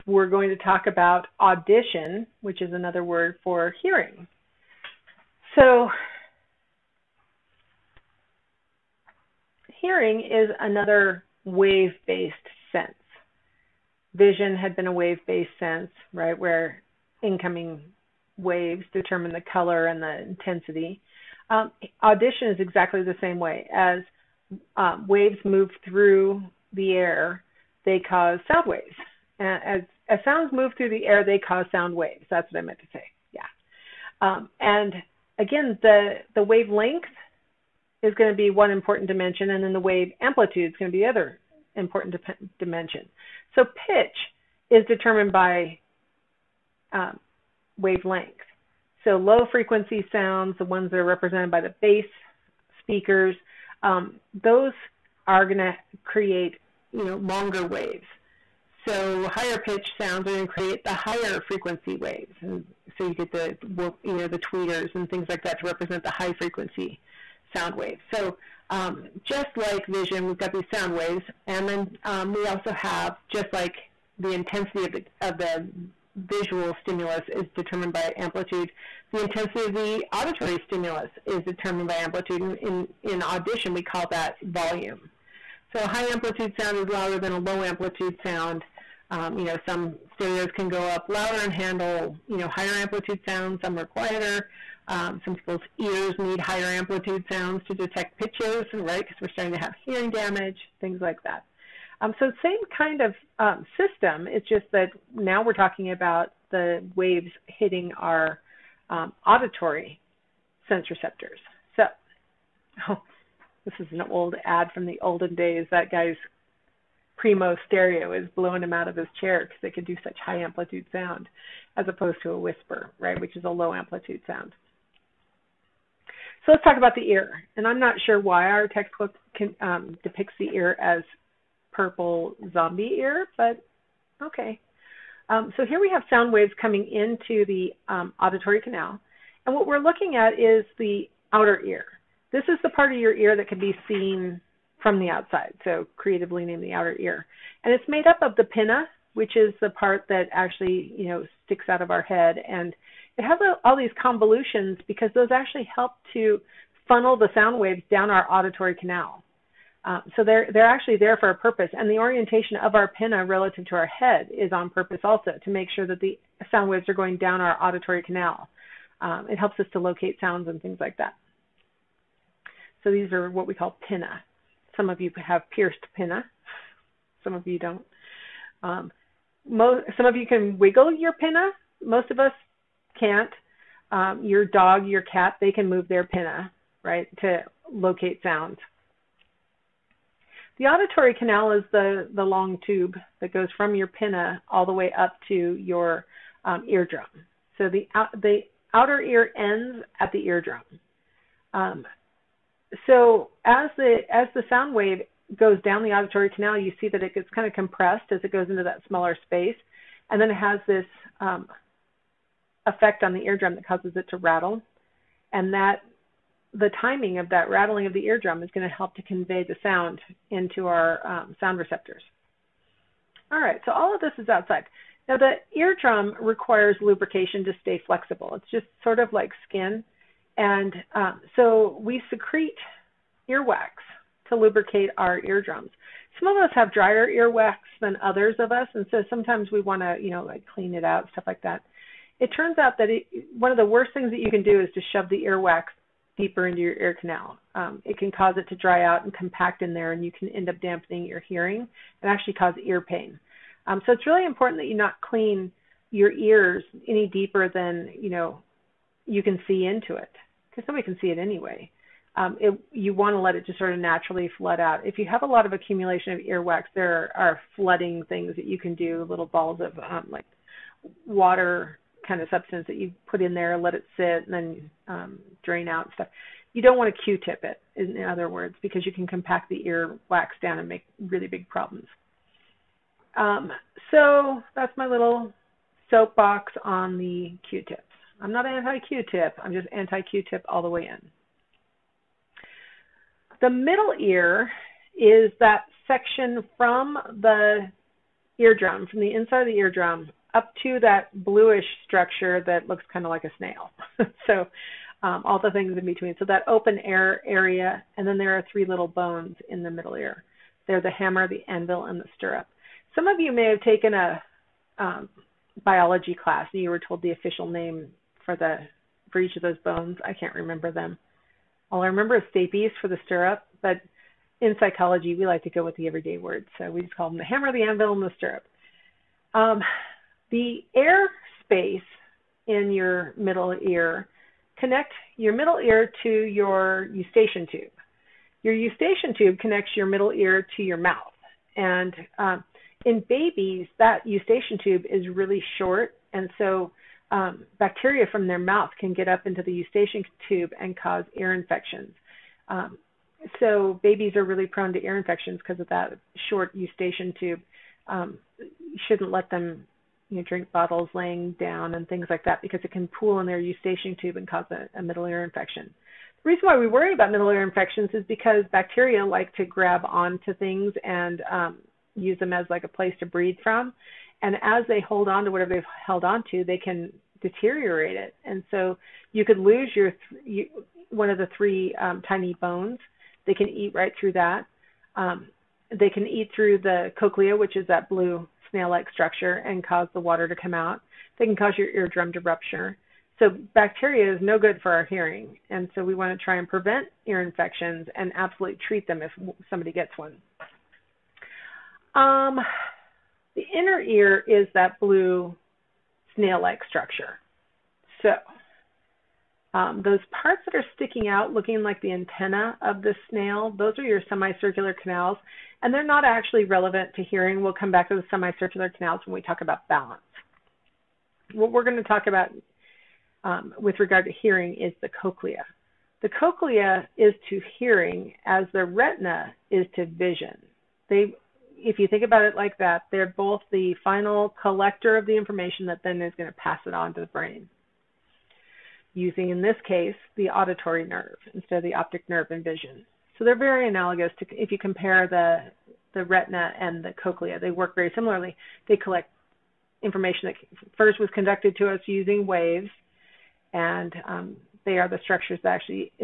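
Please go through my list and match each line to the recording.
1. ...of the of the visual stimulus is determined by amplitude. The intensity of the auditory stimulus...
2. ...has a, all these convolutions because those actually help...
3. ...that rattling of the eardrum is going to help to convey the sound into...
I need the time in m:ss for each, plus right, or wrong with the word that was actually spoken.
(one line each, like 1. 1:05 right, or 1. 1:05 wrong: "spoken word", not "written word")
1. 1:14 right
2. 2:33 right
3. 3:37 right.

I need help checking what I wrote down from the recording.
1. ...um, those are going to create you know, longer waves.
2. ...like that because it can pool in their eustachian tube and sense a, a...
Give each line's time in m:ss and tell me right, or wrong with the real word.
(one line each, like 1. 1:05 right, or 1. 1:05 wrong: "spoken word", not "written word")
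1. 0:53 right
2. 6:02 wrong: "cause", not "sense".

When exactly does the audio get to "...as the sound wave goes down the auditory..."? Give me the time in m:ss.
3:24.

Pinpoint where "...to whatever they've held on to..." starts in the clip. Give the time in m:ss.
6:15.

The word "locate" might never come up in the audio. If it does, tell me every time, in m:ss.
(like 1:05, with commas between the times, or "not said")
2:49, 3:07.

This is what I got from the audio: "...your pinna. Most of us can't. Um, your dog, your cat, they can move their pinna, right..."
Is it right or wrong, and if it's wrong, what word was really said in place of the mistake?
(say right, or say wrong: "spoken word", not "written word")
right.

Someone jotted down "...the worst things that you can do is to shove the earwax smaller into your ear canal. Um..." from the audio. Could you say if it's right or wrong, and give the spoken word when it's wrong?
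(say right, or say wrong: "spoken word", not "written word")
wrong: "deeper", not "smaller".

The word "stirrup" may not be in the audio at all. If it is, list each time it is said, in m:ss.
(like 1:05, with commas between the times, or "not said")
5:12, 5:23, 5:28.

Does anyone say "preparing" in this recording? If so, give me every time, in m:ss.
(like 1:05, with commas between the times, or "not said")
not said.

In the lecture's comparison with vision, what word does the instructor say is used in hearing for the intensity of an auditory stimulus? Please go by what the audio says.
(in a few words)
volume.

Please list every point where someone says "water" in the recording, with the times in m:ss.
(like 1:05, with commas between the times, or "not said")
4:31, 6:30.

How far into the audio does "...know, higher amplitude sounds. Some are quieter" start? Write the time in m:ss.
1:32.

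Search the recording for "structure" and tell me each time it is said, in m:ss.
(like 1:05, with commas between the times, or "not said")
5:01, 6:28, 6:46, 7:35.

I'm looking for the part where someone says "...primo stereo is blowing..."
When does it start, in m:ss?
1:57.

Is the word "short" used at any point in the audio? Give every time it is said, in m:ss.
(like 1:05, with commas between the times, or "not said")
5:45, 5:56.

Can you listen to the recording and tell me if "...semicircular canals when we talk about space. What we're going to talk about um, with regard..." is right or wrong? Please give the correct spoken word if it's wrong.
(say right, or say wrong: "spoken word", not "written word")
wrong: "balance", not "space".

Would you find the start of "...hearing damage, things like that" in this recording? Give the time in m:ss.
1:39.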